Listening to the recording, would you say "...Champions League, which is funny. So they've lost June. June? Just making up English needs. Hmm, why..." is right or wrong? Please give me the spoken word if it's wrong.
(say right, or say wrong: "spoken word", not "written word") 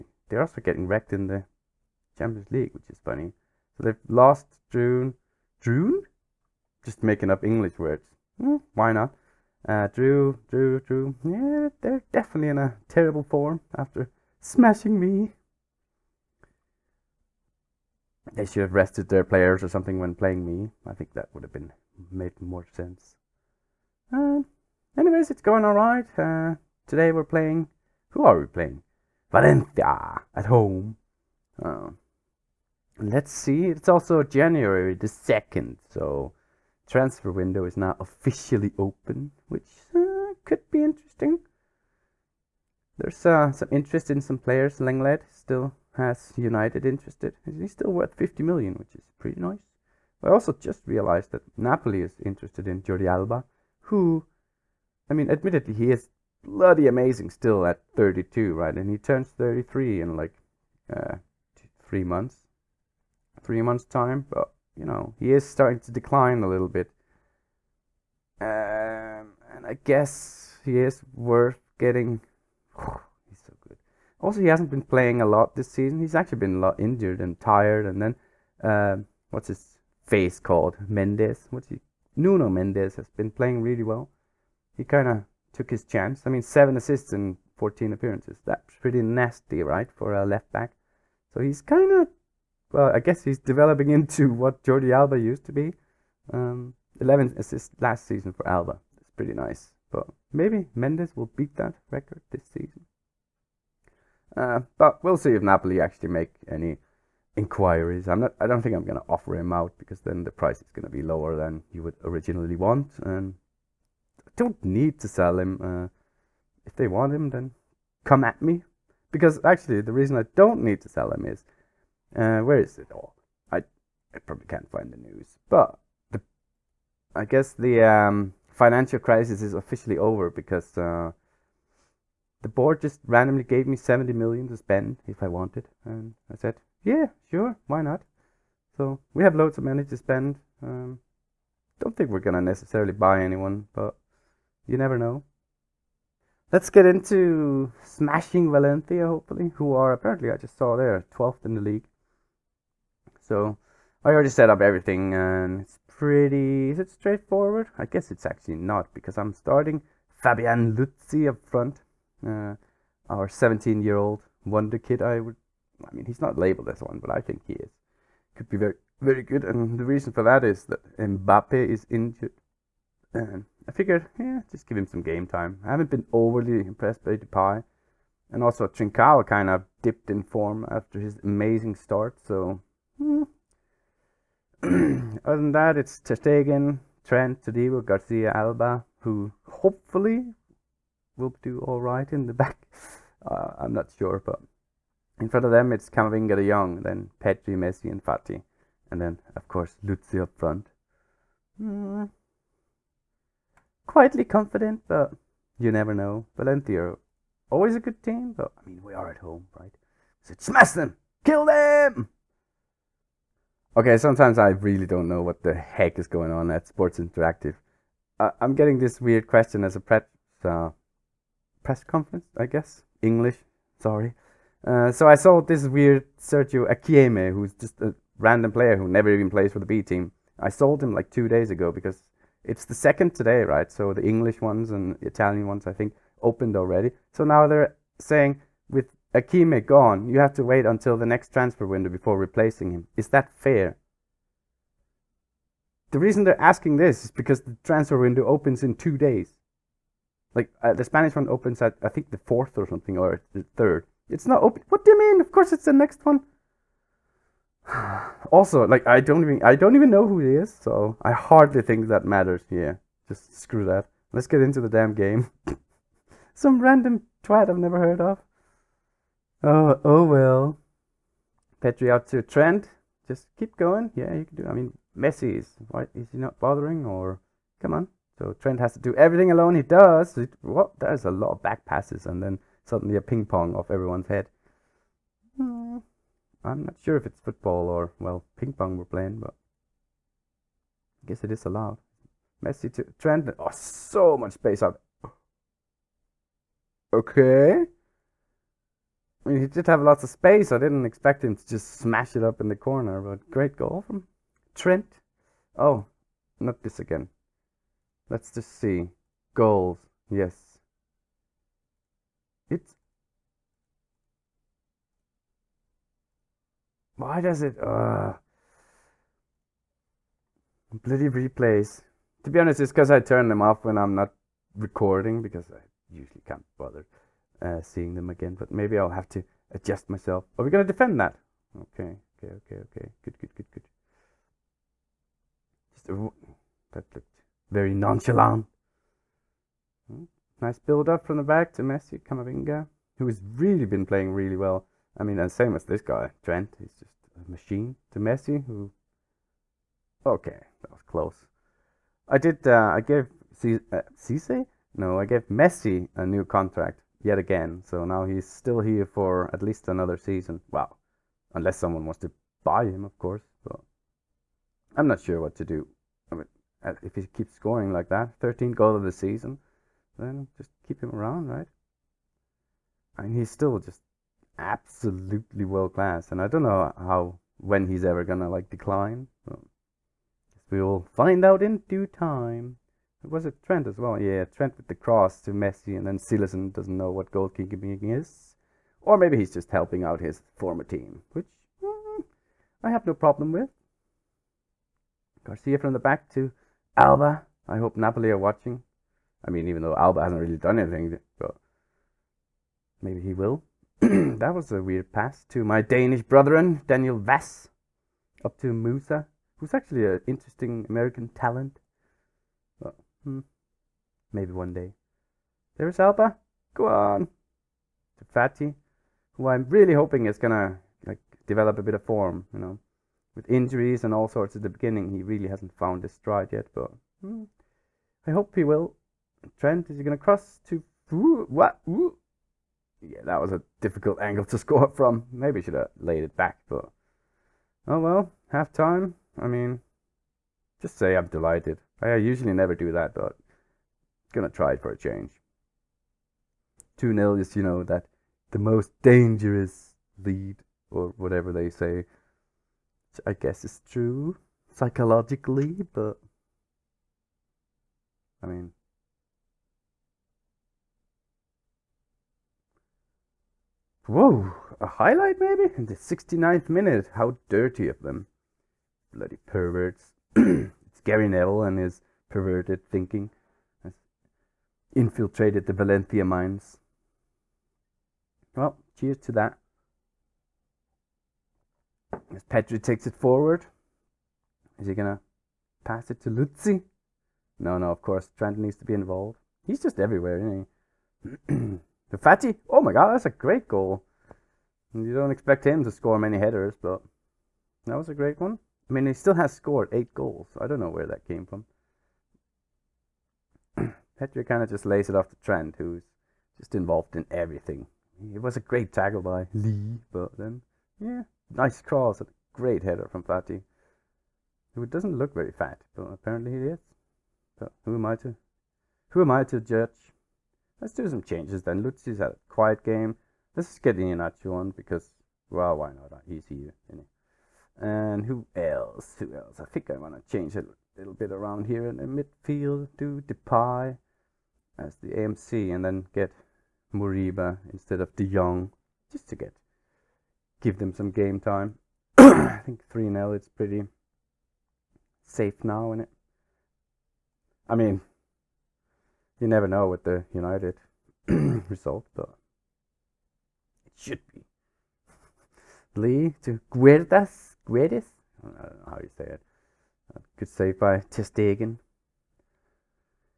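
wrong: "words", not "needs".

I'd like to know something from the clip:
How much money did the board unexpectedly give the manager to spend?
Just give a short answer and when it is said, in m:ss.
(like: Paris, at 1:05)
70 million, at 2:13.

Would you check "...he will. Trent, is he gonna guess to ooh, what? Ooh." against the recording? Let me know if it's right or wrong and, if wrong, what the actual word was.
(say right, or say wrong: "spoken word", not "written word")
wrong: "cross", not "guess".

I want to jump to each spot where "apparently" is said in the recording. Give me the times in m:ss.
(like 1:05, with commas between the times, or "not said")
2:29, 8:35.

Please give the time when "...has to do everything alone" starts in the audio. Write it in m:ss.
4:38.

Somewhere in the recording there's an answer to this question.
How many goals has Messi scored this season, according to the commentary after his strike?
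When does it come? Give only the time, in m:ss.
6:08.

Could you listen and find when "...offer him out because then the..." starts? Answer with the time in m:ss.
1:49.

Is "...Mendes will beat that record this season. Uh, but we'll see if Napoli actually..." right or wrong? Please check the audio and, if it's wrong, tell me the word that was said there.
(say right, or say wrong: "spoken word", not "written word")
right.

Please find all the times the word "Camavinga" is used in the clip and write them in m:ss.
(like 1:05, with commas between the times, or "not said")
3:15, 5:42.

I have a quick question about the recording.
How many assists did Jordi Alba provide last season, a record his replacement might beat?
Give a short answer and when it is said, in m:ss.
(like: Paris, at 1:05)
11, at 1:36.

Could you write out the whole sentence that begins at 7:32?
Which I guess is true, psychologically, but.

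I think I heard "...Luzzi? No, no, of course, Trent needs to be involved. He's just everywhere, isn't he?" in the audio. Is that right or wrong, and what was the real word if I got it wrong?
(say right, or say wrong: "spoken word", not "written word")
right.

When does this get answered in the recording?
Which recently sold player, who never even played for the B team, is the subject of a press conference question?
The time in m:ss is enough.
3:46.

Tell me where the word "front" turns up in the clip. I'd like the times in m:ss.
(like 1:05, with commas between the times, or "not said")
2:41, 3:15, 3:20.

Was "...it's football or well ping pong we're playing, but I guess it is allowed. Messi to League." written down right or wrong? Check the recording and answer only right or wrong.
wrong.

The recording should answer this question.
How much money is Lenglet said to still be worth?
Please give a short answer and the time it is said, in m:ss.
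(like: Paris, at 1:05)
50 million, at 0:48.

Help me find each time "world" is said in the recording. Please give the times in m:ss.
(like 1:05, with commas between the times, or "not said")
6:15.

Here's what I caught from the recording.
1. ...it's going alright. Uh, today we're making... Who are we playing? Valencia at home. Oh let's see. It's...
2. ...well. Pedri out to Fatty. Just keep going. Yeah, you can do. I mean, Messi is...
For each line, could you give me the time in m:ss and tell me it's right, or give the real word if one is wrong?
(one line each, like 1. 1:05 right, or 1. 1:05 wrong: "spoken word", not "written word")
1. 0:25 wrong: "playing", not "making"
2. 4:30 wrong: "Trent", not "Fatty".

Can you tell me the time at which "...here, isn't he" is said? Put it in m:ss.
8:46.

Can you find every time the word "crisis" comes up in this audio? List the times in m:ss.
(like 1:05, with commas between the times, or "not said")
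2:08.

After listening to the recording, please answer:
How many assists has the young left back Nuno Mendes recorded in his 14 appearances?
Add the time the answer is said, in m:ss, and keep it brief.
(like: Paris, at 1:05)
7, at 1:26.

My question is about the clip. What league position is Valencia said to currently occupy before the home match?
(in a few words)
12th.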